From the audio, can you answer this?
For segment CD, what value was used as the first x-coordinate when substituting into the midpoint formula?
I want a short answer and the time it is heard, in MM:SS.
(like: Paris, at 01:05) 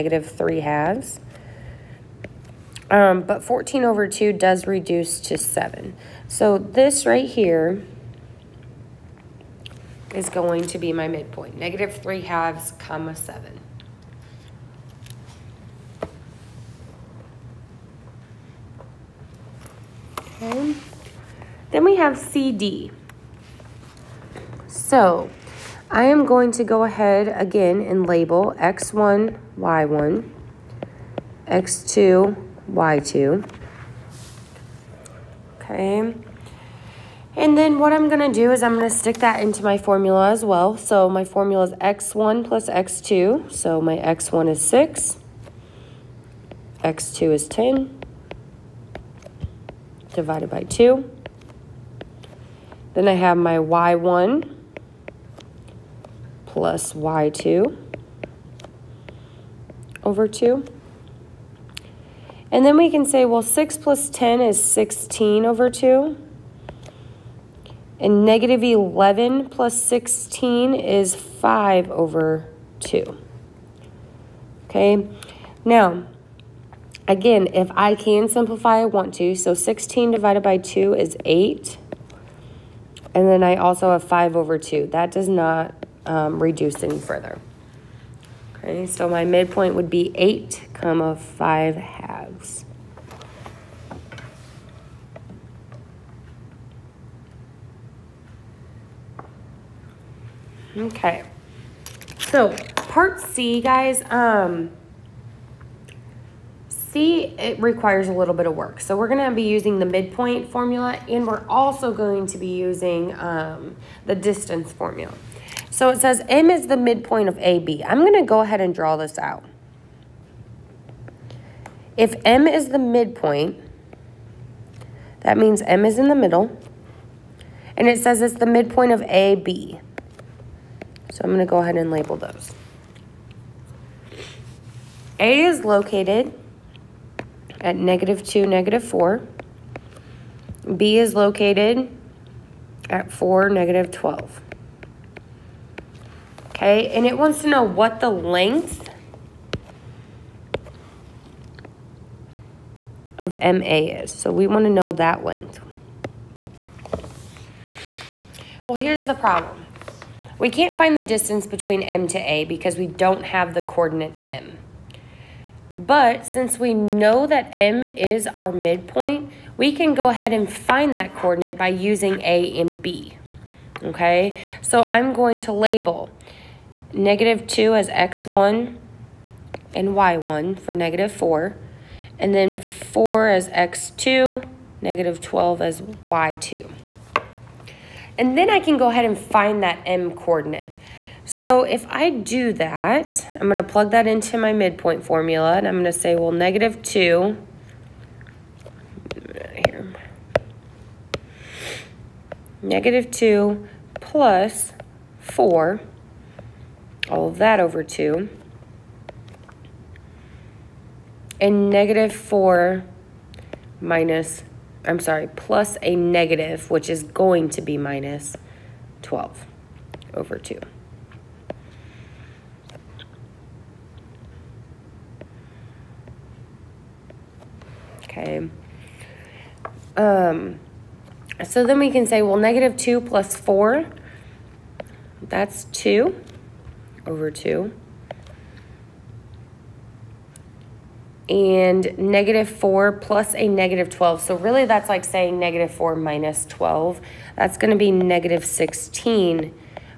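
6, at 00:43.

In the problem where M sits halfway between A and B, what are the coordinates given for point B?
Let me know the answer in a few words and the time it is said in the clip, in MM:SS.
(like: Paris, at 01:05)
(4, -12), at 02:23.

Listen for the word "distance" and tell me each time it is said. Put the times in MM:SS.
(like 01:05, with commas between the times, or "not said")
01:54, 02:41.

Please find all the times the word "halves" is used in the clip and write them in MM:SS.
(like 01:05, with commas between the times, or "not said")
00:00, 00:12, 01:31.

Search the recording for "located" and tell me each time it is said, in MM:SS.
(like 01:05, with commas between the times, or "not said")
02:15, 02:21.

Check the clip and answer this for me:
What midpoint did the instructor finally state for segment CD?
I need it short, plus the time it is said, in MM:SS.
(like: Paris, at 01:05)
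8, 5/2, at 01:30.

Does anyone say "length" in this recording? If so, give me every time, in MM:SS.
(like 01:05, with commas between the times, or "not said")
02:28, 02:35.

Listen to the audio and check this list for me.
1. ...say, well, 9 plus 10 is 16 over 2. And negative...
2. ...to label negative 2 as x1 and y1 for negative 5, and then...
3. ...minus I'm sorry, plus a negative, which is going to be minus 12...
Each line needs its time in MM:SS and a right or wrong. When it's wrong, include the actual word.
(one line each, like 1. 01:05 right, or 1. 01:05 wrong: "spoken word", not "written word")
1. 01:03 wrong: "6", not "9"
2. 02:55 wrong: "4", not "5"
3. 03:33 right.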